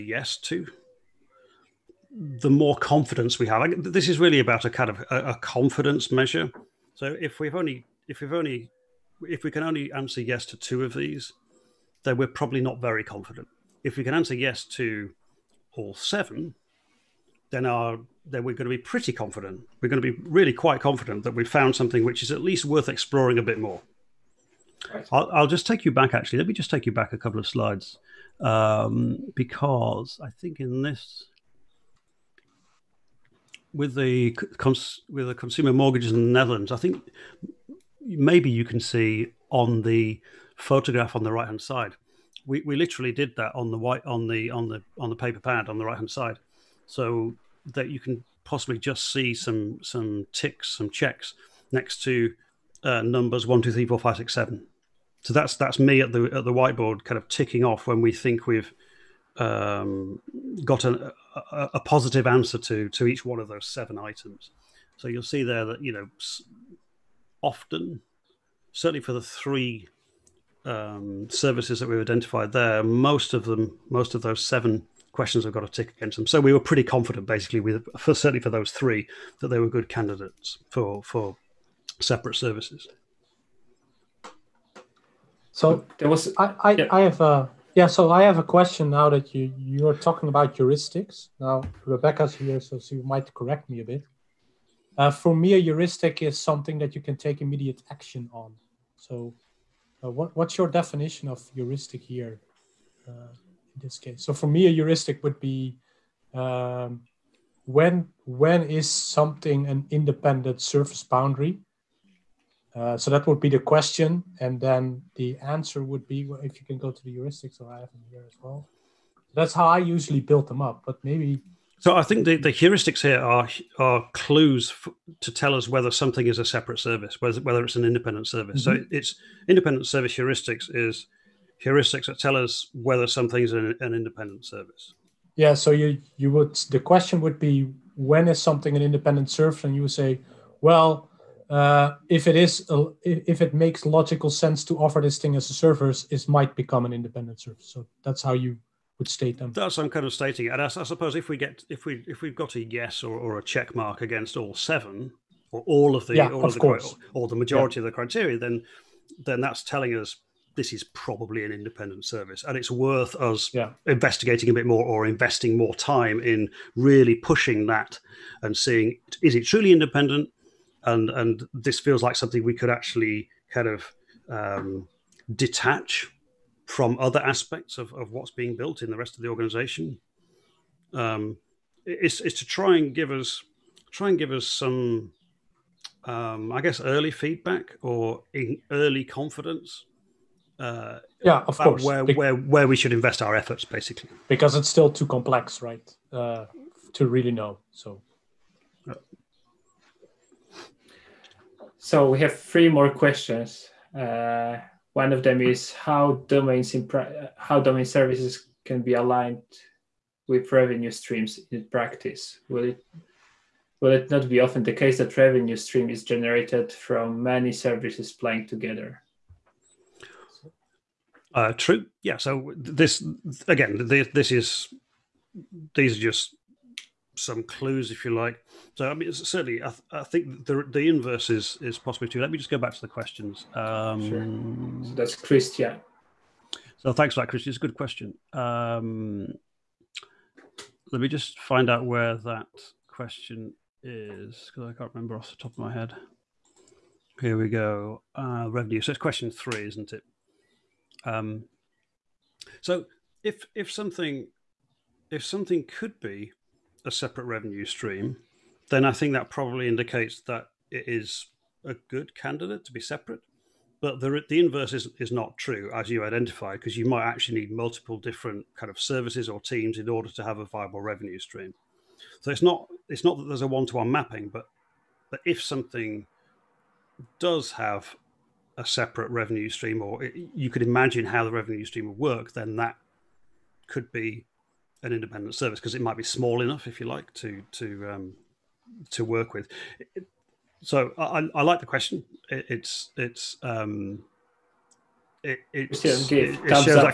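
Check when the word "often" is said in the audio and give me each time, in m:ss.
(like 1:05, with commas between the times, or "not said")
1:07, 3:34.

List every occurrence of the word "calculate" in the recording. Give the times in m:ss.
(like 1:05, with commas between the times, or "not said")
not said.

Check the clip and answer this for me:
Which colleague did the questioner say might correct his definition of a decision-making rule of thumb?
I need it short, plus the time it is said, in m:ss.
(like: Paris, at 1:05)
Rebecca, at 1:31.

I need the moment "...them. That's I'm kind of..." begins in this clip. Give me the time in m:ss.
2:29.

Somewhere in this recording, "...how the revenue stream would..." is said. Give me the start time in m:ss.
4:41.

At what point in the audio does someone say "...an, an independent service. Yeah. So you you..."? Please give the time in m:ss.
2:13.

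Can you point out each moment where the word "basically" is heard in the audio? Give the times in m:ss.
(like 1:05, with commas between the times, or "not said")
1:17, 3:13.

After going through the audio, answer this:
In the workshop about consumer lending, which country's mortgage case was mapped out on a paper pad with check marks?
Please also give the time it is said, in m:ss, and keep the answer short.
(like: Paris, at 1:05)
The Netherlands, at 0:36.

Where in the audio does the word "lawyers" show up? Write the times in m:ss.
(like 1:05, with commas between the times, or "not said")
not said.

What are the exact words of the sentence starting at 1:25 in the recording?
So there was I I, yeah.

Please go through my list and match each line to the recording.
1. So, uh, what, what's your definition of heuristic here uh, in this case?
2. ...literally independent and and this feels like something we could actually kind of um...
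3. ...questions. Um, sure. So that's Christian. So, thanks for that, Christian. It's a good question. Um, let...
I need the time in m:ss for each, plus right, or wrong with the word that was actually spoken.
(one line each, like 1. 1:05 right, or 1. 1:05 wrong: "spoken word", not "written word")
1. 1:38 right
2. 2:49 wrong: "truly", not "literally"
3. 3:52 right.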